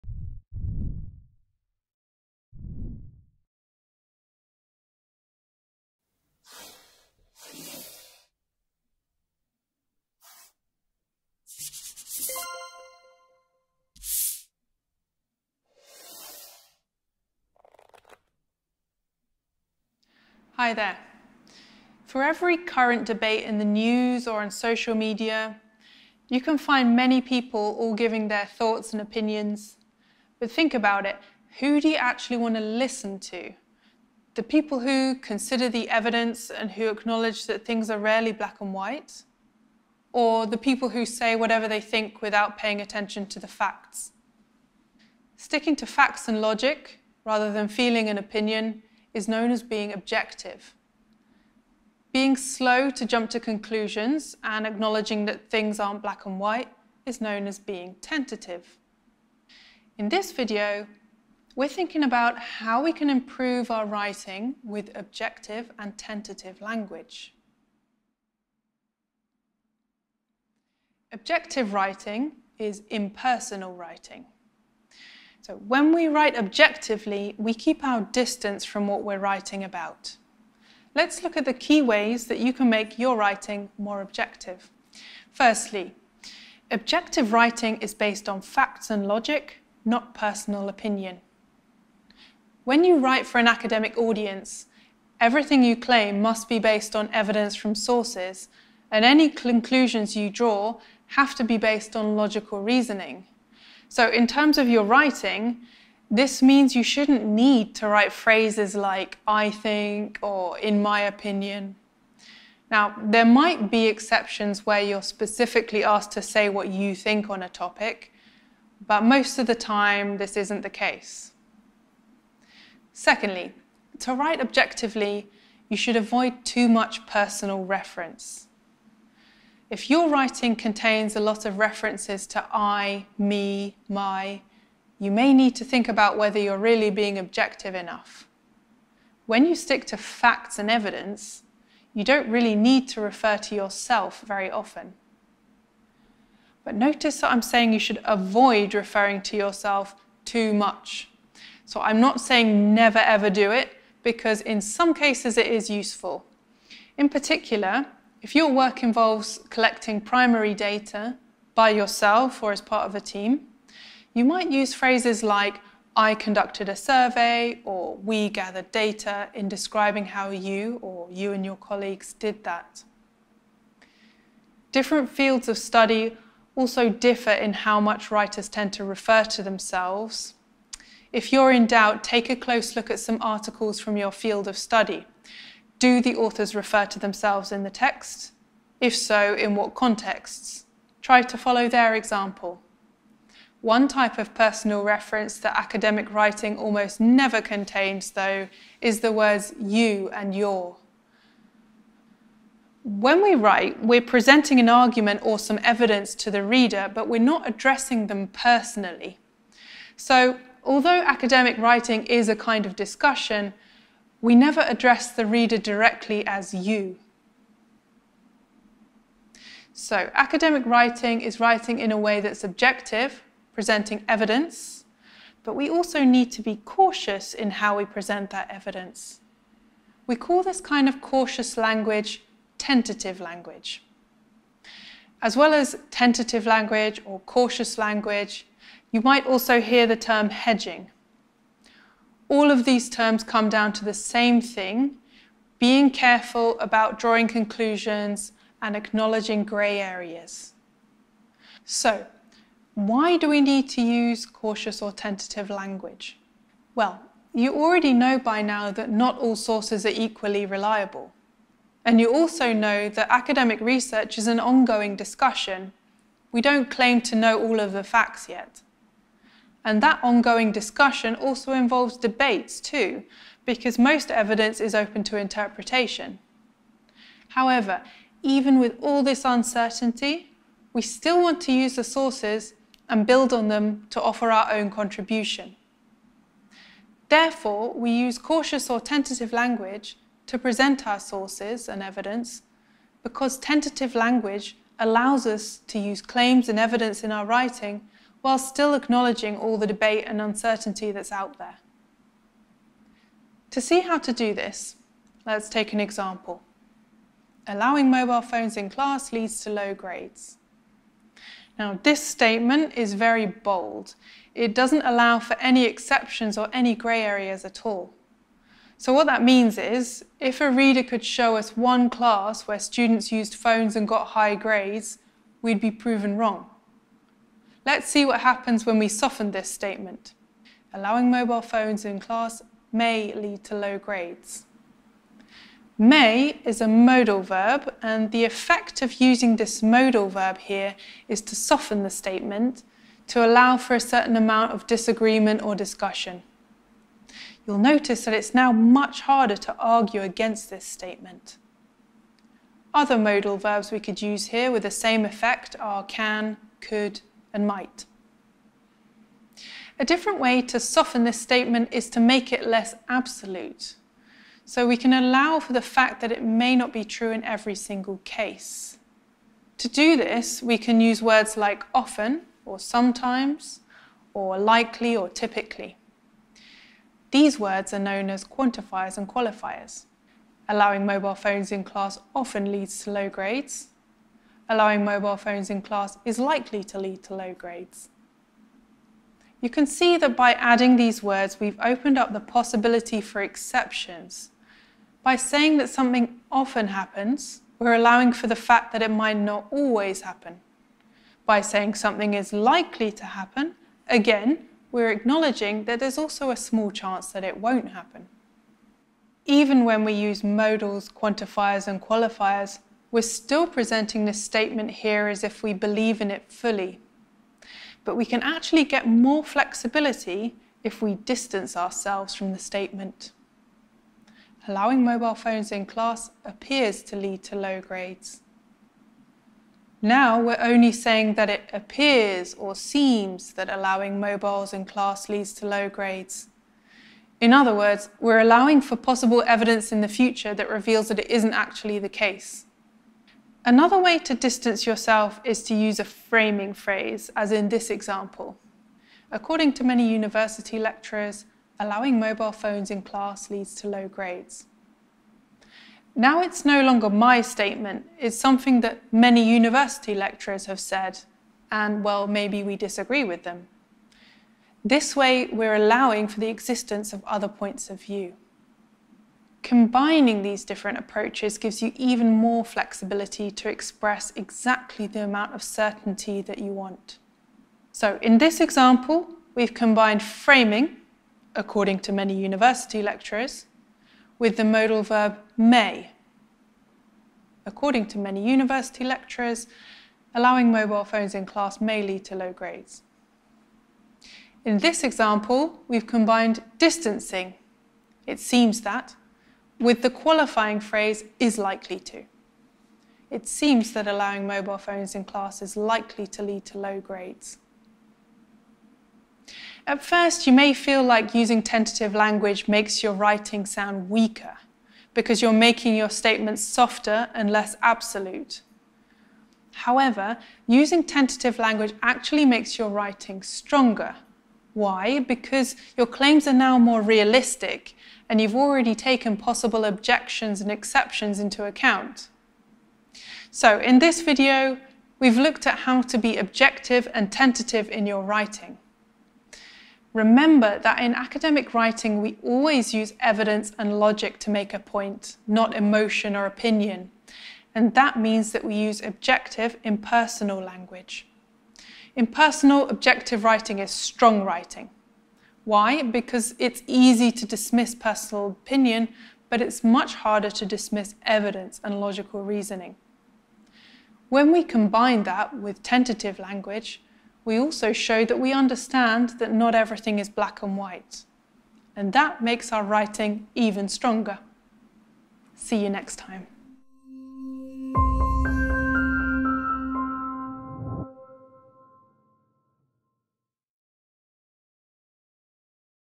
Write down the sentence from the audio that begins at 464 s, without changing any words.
This way, we're allowing for the existence of other points of view.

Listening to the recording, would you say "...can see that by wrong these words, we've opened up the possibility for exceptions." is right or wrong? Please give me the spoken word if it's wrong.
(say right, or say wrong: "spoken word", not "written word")
wrong: "adding", not "wrong".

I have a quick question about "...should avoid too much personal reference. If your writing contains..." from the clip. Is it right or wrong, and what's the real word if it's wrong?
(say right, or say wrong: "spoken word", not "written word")
right.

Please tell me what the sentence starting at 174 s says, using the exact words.
Different fields of study also differ in how much writers tend to refer to themselves.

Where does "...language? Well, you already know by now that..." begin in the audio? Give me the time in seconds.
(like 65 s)
255 s.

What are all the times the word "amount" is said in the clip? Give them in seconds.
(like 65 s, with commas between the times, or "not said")
344 s, 475 s.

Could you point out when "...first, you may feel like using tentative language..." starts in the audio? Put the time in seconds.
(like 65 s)
509 s.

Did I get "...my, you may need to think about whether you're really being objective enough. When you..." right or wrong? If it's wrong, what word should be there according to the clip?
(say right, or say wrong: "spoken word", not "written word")
right.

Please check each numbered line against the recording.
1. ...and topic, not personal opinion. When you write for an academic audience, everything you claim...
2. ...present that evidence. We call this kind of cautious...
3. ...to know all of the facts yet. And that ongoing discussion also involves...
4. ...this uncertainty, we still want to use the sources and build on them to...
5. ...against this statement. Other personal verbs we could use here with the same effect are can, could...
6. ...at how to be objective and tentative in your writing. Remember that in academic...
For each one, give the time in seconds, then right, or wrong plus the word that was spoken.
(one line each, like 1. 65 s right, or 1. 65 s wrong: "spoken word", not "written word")
1. 88 s wrong: "logic", not "topic"
2. 227 s right
3. 267 s right
4. 279 s right
5. 350 s wrong: "modal", not "personal"
6. 535 s right.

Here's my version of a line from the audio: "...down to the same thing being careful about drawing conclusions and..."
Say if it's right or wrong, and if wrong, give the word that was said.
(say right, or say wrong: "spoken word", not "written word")
right.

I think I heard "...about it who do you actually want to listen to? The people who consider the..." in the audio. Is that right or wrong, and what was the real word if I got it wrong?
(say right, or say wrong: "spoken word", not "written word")
right.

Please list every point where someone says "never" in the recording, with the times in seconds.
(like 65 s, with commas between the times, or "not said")
152 s, 196 s, 214 s.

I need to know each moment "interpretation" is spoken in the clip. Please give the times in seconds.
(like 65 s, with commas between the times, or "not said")
275 s.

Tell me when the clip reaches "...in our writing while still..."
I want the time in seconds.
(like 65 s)
297 s.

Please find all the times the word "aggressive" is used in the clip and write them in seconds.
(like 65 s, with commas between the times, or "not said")
not said.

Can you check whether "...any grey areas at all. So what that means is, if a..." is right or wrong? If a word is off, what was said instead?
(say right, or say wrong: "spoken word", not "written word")
right.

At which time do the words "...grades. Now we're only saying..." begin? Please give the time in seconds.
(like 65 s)
427 s.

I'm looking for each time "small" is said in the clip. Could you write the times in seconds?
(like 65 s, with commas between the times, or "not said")
406 s.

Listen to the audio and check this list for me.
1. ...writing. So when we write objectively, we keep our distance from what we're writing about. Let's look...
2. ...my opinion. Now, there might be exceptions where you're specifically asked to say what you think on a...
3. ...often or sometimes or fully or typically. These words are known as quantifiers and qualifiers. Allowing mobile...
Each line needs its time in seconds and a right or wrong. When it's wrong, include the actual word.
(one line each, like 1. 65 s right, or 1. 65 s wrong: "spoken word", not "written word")
1. 73 s right
2. 110 s right
3. 371 s wrong: "likely", not "fully".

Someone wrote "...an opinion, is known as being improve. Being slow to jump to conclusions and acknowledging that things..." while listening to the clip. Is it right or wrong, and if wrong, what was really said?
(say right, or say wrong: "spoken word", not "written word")
wrong: "objective", not "improve".